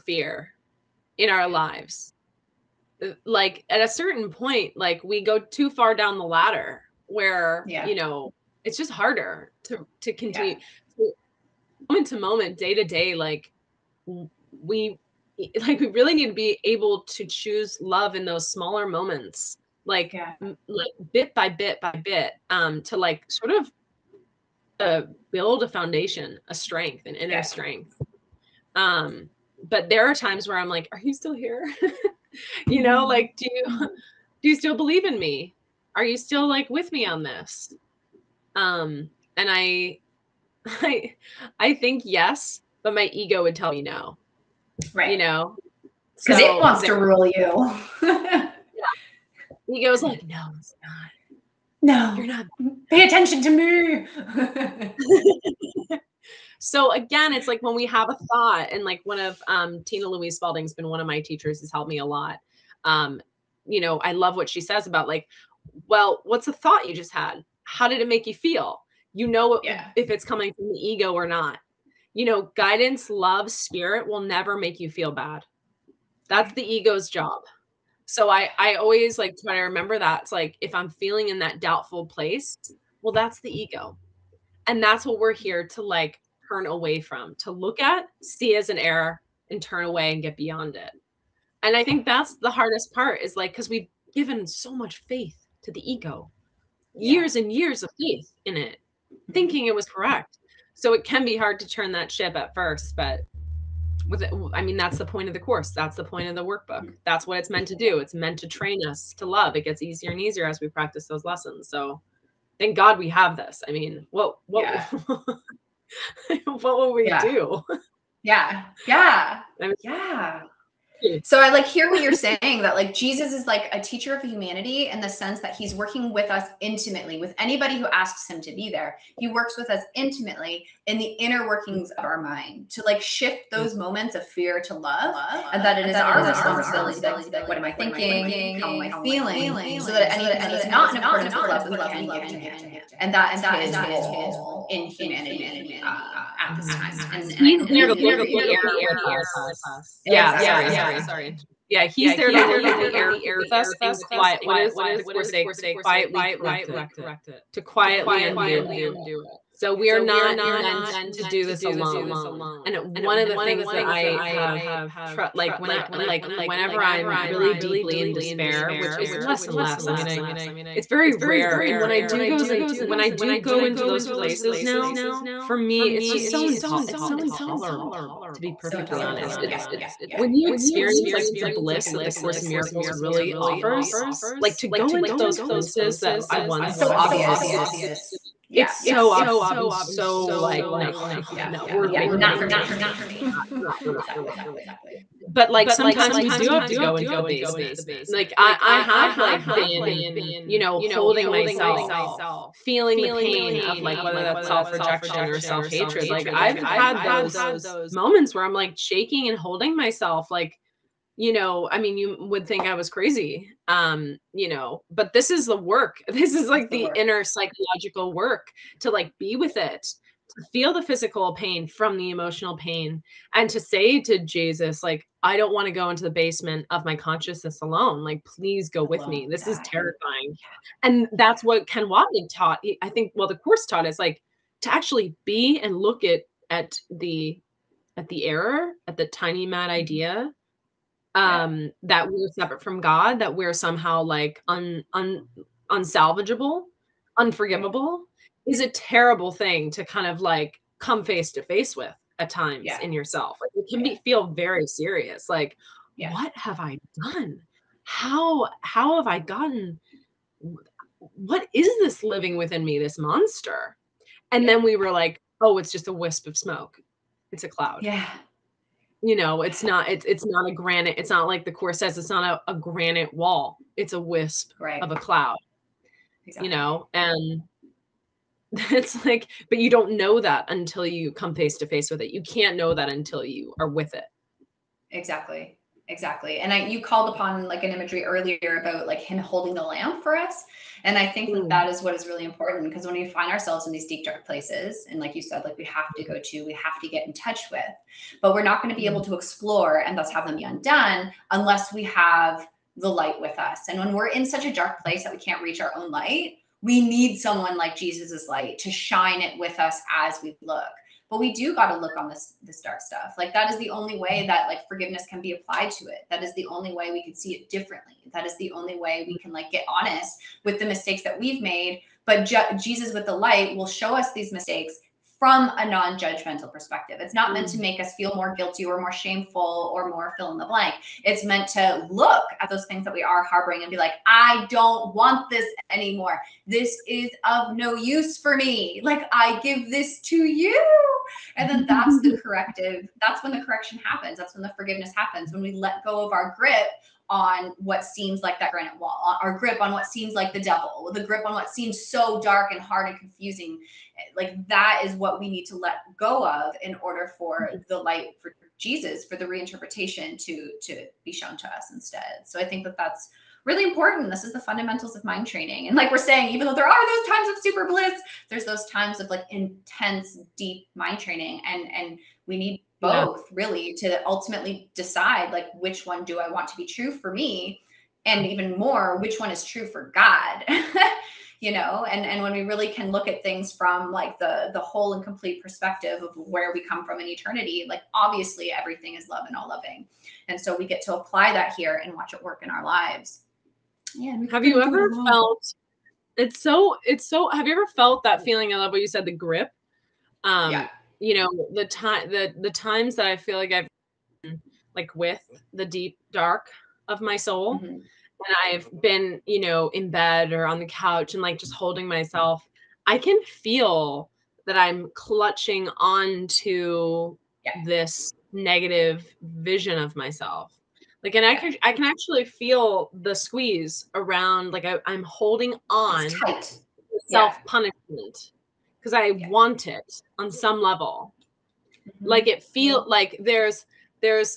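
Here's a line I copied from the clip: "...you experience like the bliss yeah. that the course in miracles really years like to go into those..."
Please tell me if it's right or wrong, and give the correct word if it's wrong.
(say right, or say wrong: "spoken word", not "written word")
wrong: "offers", not "years".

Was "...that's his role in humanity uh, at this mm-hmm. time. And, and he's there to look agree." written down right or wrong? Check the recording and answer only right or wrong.
right.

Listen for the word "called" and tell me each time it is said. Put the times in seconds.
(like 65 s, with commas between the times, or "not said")
286 s.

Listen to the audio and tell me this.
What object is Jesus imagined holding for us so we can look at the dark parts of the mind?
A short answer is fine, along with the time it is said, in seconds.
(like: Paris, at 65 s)
the lamp, at 289 s.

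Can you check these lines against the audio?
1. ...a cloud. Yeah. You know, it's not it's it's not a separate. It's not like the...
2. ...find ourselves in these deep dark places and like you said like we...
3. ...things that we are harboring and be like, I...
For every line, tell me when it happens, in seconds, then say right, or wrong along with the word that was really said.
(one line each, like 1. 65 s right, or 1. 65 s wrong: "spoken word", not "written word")
1. 267 s wrong: "granite", not "separate"
2. 293 s right
3. 332 s right.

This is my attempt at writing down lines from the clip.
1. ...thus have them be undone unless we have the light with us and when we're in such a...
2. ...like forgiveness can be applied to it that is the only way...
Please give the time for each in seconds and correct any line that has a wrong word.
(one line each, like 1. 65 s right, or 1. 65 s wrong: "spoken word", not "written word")
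1. 299 s right
2. 314 s right.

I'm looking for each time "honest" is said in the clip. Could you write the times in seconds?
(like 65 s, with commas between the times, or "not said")
179 s, 319 s.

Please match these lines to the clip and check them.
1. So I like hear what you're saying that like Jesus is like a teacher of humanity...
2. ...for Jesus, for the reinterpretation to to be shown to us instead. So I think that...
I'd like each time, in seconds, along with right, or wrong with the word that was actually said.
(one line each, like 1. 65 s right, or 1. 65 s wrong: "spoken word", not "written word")
1. 121 s right
2. 358 s right.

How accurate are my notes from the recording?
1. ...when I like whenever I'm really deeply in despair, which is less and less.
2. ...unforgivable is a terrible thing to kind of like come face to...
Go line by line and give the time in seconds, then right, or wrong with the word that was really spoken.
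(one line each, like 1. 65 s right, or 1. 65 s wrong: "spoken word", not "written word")
1. 165 s right
2. 247 s right.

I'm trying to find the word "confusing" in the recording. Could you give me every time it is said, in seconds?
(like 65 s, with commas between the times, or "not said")
352 s.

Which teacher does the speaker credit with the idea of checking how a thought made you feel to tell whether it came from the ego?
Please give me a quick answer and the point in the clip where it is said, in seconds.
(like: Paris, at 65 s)
Tina Louise Spalding, at 59 s.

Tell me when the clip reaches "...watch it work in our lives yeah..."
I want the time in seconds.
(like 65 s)
391 s.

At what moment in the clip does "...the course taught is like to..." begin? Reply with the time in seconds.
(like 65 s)
233 s.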